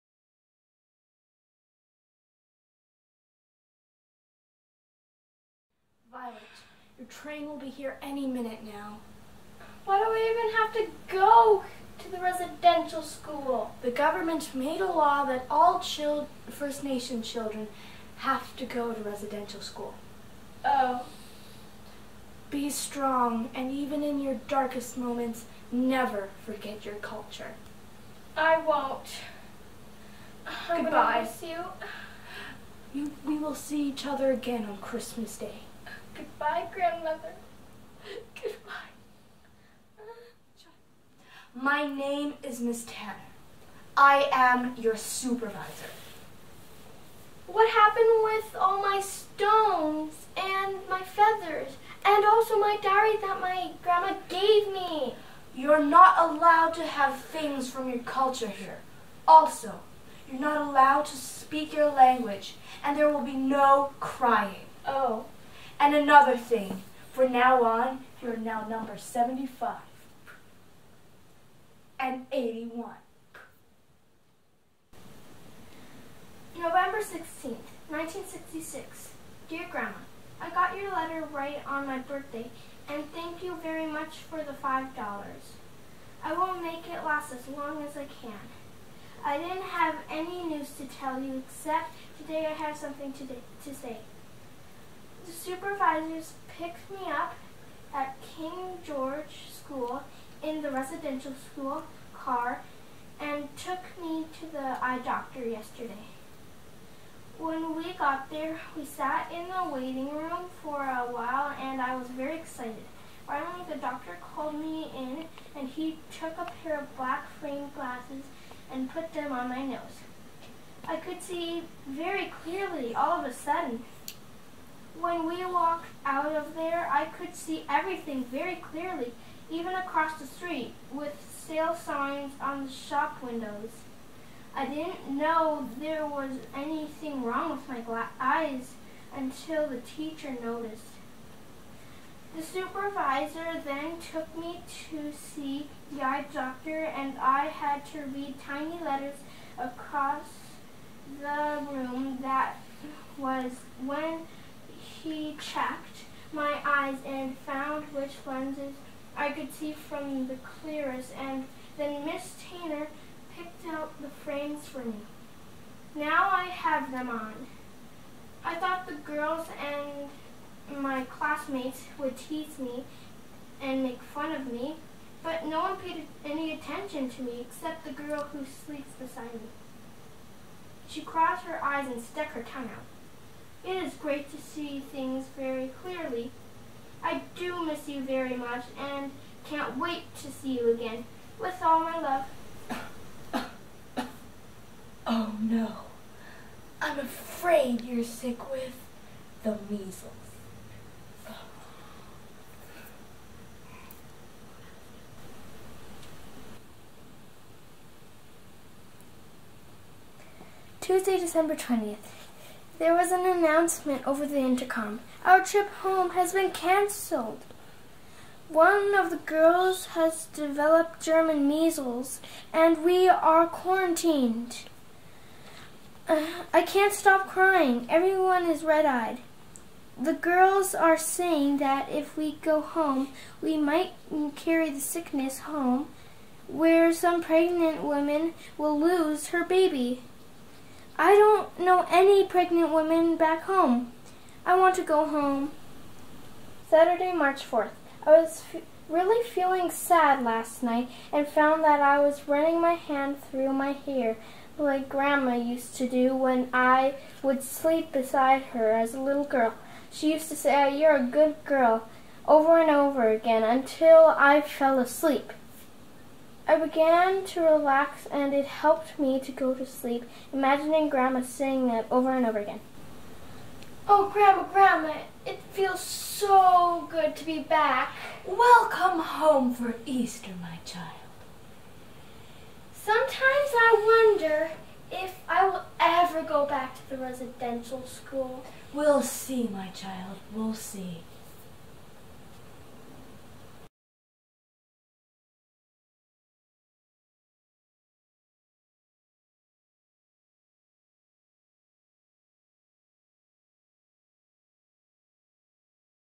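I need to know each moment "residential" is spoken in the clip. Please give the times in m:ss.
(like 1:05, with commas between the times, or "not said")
0:12, 0:19, 1:40, 4:47.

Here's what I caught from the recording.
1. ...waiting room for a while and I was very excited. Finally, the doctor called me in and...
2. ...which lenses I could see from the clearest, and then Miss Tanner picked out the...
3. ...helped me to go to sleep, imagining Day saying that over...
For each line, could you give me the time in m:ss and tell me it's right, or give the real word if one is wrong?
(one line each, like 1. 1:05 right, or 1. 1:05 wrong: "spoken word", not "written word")
1. 1:49 right
2. 2:37 right
3. 4:28 wrong: "Grandma", not "Day".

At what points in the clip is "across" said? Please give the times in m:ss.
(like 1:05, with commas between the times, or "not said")
2:09, 2:29.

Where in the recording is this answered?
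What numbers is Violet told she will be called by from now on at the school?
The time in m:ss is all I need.
1:08.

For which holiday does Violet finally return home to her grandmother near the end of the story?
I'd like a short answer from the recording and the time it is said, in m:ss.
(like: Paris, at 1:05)
Easter, at 4:39.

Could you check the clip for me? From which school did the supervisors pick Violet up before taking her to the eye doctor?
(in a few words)
King George School.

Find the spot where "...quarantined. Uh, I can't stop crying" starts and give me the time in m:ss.
3:43.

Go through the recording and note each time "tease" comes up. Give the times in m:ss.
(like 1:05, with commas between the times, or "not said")
2:52.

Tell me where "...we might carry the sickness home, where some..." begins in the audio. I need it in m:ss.
3:53.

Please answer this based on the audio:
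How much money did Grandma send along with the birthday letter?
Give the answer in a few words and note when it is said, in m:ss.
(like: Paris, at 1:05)
$5, at 1:24.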